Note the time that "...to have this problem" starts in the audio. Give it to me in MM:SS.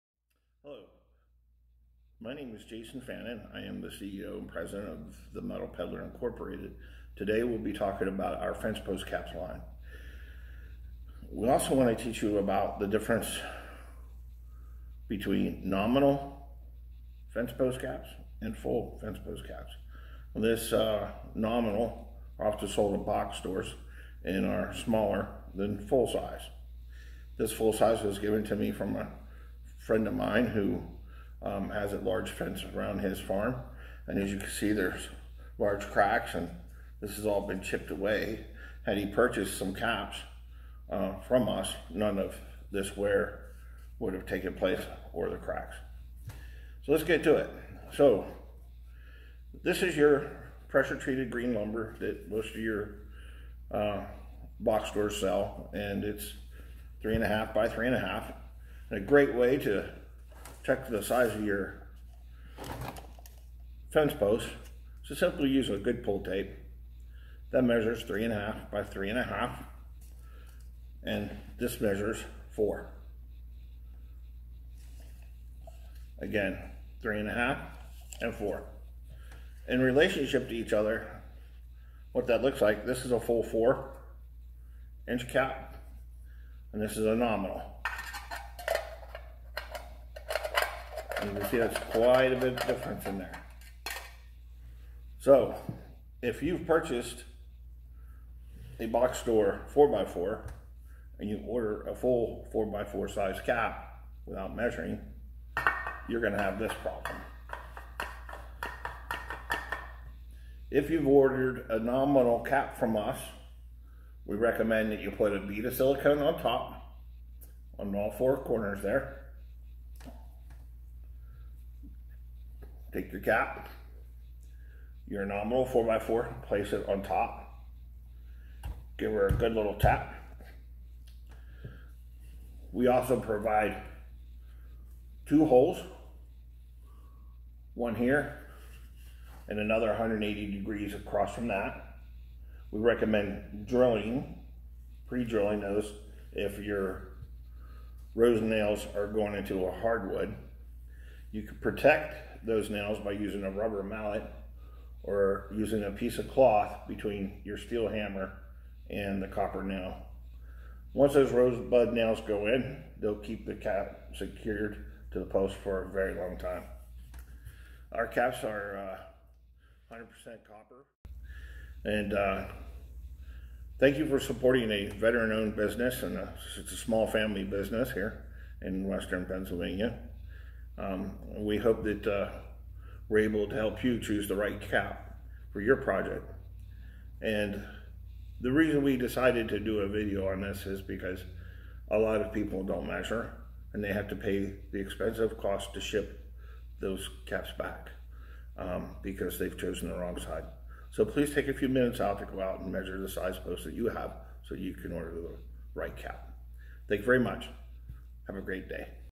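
01:46.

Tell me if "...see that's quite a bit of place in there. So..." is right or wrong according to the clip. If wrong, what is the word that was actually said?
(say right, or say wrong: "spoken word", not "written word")
wrong: "difference", not "place".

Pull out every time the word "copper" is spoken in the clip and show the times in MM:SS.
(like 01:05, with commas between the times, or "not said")
02:39, 02:50.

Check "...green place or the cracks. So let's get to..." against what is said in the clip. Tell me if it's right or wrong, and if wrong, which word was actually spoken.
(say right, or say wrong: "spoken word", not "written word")
wrong: "taken", not "green".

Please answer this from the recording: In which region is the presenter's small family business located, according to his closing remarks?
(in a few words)
Western Pennsylvania.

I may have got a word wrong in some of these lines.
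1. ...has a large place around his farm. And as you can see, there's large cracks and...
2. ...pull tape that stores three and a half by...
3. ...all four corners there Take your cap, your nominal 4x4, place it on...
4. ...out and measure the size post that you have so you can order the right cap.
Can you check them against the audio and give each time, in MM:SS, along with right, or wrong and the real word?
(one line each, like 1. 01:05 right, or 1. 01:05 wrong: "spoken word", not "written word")
1. 00:31 wrong: "fence", not "place"
2. 01:06 wrong: "measures", not "stores"
3. 01:57 right
4. 03:22 right.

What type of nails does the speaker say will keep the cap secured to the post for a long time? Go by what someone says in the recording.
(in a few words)
rosebud nails.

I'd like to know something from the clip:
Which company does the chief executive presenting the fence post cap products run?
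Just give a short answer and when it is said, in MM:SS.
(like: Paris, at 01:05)
Metal Peddler Incorporated, at 00:05.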